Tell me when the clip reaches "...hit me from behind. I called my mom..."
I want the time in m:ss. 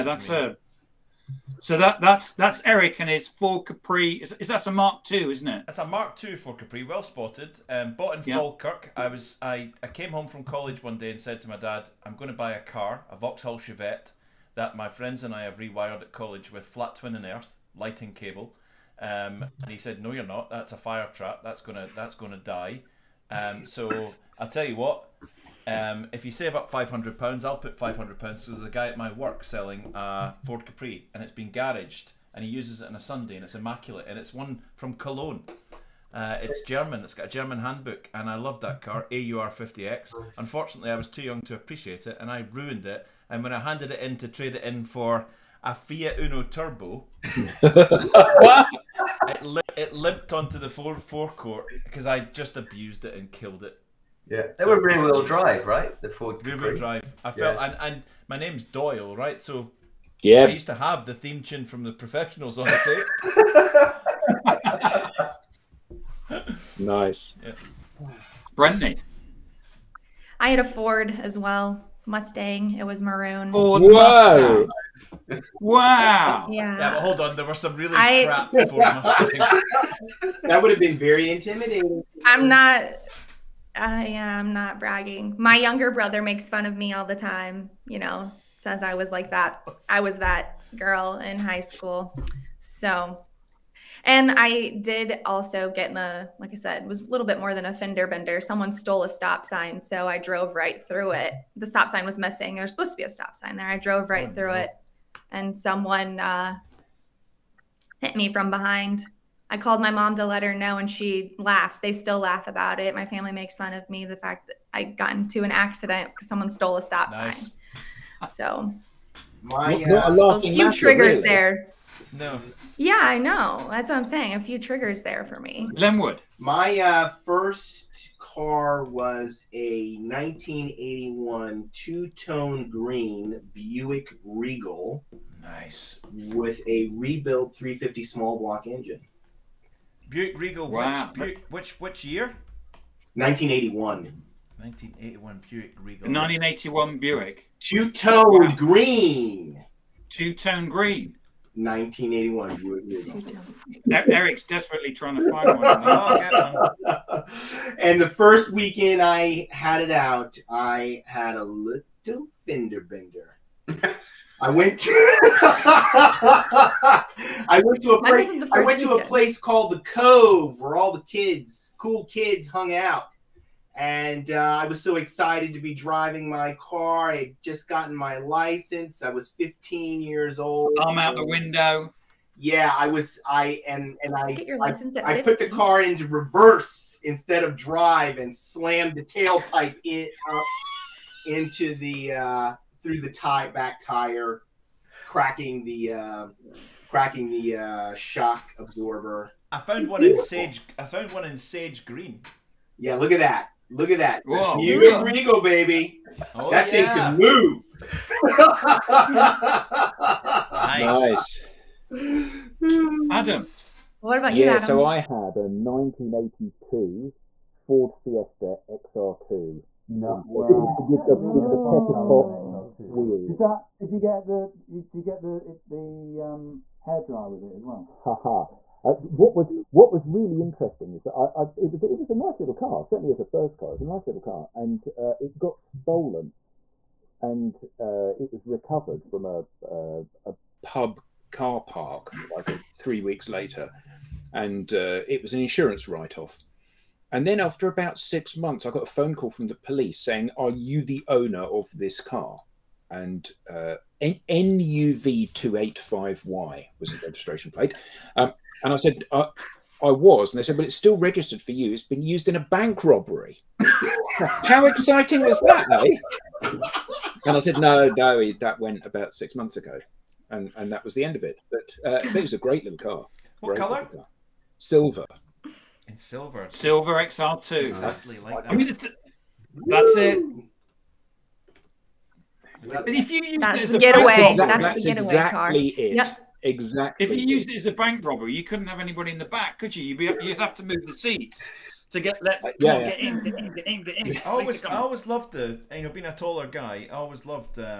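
1:47.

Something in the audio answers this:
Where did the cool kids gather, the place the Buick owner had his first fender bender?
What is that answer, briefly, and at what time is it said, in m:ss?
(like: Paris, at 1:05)
the Cove, at 2:49.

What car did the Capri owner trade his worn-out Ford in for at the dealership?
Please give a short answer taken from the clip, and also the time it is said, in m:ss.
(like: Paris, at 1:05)
Fiat Uno Turbo, at 0:45.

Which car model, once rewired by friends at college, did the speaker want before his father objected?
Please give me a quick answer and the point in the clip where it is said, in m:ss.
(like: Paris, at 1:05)
Vauxhall Chevette, at 0:13.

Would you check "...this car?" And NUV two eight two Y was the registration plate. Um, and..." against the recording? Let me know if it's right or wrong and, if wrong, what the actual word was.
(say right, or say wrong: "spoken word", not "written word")
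wrong: "five", not "two".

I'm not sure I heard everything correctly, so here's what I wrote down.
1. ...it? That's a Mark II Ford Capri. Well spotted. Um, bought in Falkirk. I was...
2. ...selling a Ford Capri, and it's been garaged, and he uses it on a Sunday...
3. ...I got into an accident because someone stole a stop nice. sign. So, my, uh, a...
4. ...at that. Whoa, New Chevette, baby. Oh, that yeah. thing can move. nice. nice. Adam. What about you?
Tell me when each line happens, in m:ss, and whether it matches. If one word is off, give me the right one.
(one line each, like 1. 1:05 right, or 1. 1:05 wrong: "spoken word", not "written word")
1. 0:05 right
2. 0:29 right
3. 1:54 right
4. 3:23 wrong: "Regal", not "Chevette".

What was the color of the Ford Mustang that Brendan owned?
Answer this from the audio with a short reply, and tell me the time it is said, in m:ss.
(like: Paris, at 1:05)
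Maroon, at 1:13.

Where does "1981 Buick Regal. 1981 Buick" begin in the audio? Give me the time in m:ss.
2:24.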